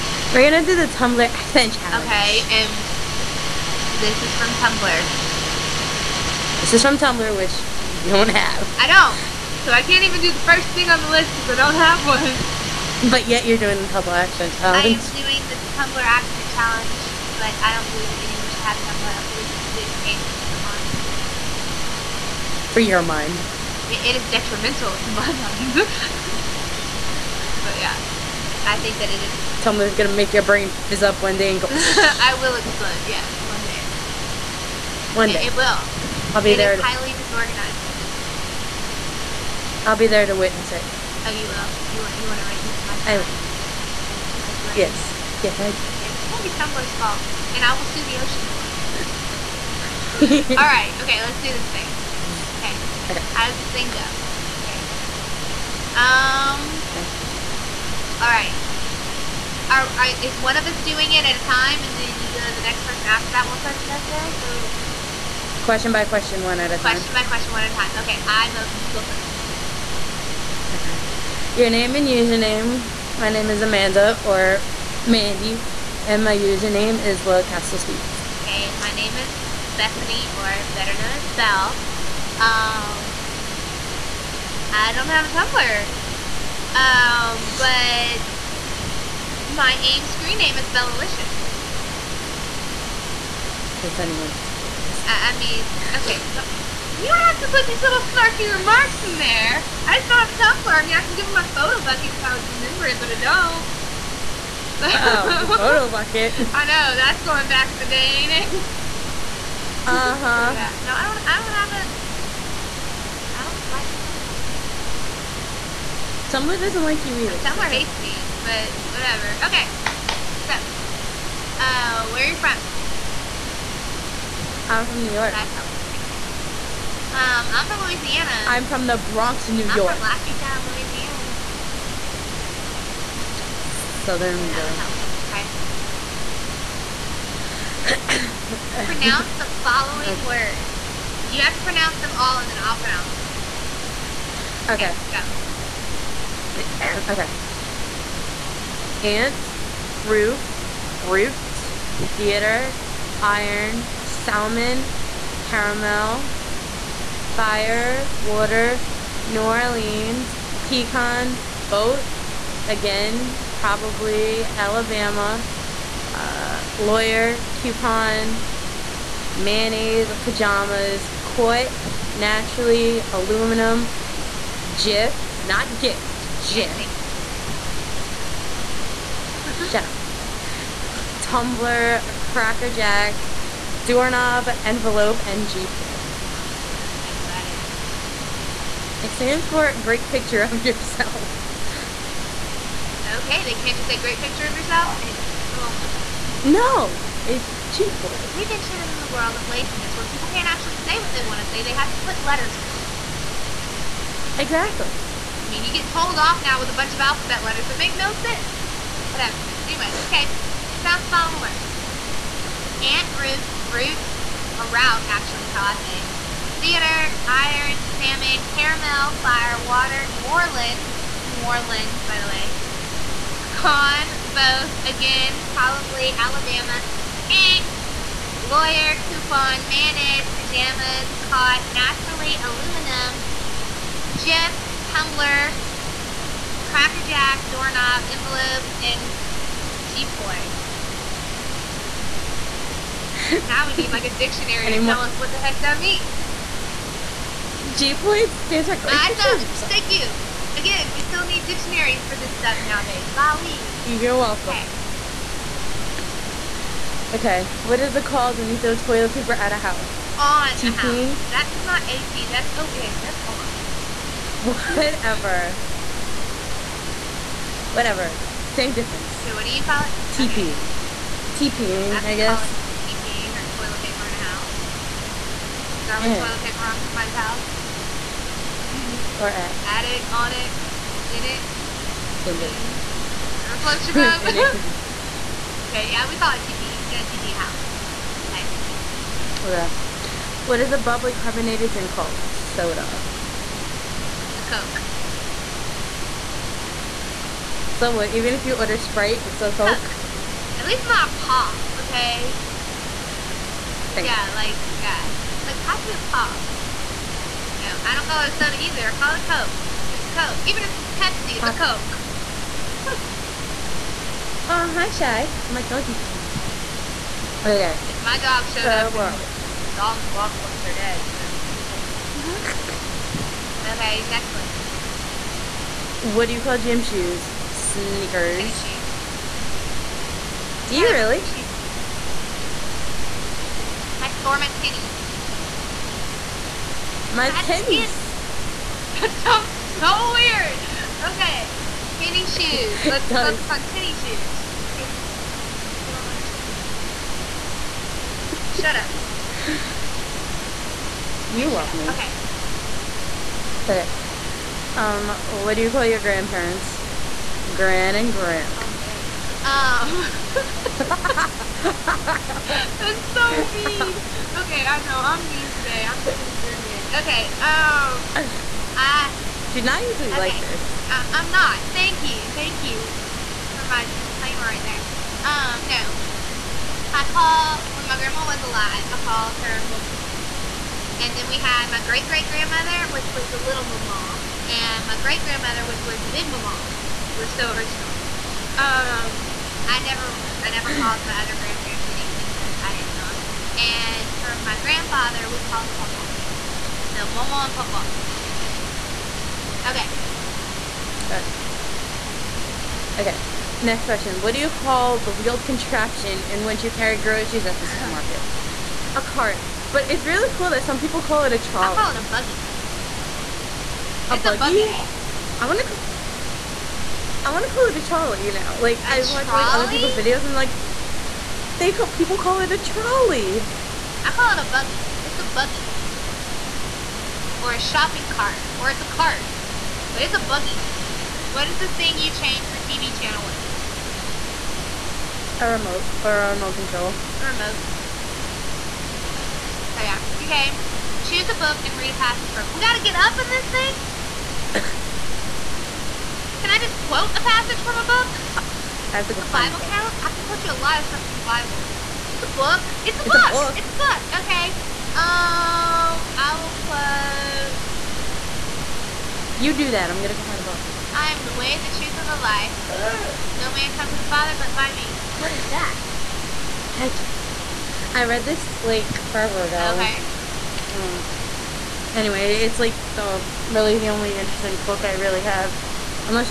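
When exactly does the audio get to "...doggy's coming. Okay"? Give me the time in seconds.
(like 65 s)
315 s.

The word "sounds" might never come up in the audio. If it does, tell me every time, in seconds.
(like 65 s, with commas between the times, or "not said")
210 s, 339 s.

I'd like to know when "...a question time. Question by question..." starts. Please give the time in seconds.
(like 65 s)
66 s.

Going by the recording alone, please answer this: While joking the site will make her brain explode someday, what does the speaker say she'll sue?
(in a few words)
The ocean.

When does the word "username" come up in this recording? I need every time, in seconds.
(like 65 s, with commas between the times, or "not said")
72 s, 76 s.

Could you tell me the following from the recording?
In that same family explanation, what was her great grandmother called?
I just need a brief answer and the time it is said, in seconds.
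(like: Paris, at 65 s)
Big mama, at 386 s.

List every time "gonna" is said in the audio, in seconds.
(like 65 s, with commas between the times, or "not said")
0 s, 29 s, 46 s, 459 s.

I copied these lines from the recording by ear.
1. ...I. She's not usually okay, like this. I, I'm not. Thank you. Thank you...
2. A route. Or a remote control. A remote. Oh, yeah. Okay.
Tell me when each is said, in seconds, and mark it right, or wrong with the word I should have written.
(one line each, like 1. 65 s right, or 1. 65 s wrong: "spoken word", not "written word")
1. 368 s right
2. 435 s wrong: "remote", not "route".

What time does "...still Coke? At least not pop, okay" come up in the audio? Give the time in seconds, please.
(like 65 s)
299 s.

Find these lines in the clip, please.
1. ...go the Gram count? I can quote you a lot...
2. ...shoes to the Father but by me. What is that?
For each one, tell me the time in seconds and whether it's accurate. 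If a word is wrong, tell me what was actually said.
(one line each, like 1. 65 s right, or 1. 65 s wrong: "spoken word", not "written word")
1. 449 s wrong: "Bible", not "Gram"
2. 463 s wrong: "comes", not "shoes".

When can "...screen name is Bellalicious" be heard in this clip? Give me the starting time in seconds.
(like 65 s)
90 s.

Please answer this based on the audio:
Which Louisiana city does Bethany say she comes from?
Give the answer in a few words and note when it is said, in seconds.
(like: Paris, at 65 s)
Lafayette, at 130 s.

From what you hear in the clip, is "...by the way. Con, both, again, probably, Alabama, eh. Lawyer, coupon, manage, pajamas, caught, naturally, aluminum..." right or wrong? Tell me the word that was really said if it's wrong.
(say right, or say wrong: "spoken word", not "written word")
right.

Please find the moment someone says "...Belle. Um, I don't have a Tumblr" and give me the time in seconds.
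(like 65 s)
81 s.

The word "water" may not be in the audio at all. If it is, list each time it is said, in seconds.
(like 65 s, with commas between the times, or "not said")
158 s, 219 s.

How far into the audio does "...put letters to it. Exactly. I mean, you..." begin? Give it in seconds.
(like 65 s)
202 s.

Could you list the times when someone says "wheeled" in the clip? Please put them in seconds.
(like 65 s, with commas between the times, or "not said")
405 s.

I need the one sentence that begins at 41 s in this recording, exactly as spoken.
You you want to witness my demise?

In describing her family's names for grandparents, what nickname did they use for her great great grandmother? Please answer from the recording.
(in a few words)
Little mama.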